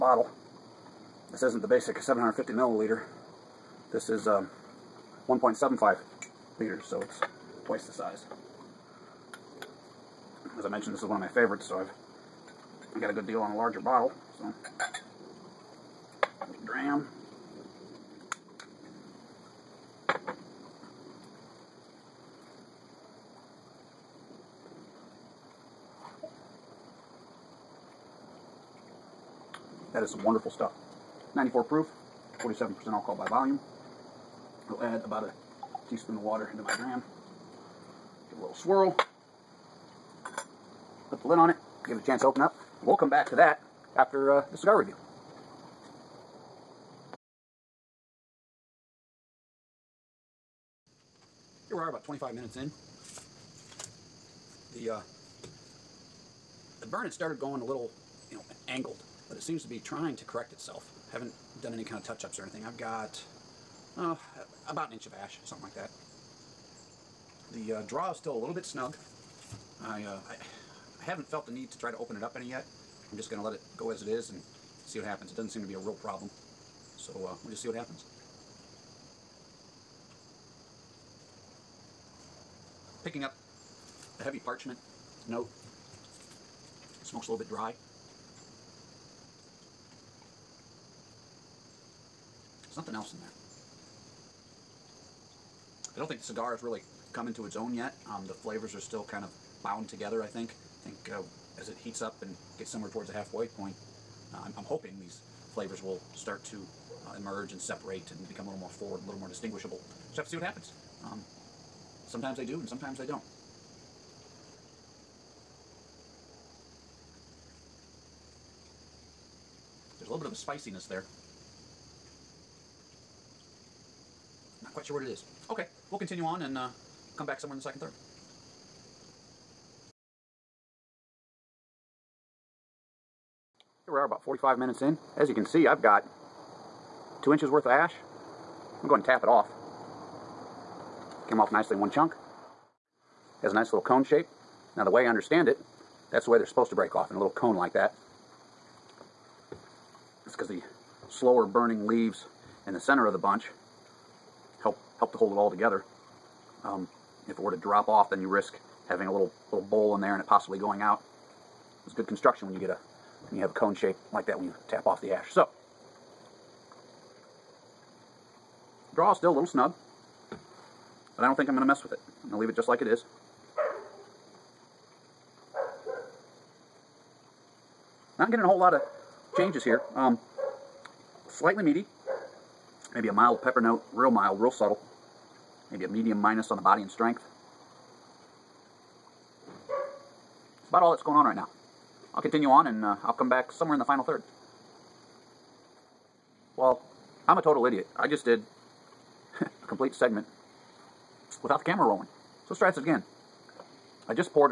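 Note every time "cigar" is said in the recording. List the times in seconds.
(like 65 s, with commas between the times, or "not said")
44 s, 96 s.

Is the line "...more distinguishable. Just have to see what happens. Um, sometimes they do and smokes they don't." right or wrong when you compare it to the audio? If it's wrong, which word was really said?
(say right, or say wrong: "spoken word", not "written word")
wrong: "sometimes", not "smokes".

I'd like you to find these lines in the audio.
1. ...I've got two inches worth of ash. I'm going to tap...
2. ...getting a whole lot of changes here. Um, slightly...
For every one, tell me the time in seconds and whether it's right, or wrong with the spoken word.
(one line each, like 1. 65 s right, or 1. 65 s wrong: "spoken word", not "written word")
1. 135 s right
2. 178 s right.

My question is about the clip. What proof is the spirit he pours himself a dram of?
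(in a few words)
94 proof.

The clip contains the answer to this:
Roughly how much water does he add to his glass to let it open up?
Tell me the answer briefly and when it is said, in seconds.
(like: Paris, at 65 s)
a teaspoon, at 35 s.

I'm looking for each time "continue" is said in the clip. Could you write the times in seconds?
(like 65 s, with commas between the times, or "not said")
125 s, 192 s.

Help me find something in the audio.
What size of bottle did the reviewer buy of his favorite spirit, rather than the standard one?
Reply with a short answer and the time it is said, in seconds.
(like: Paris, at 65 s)
1.75 liters, at 5 s.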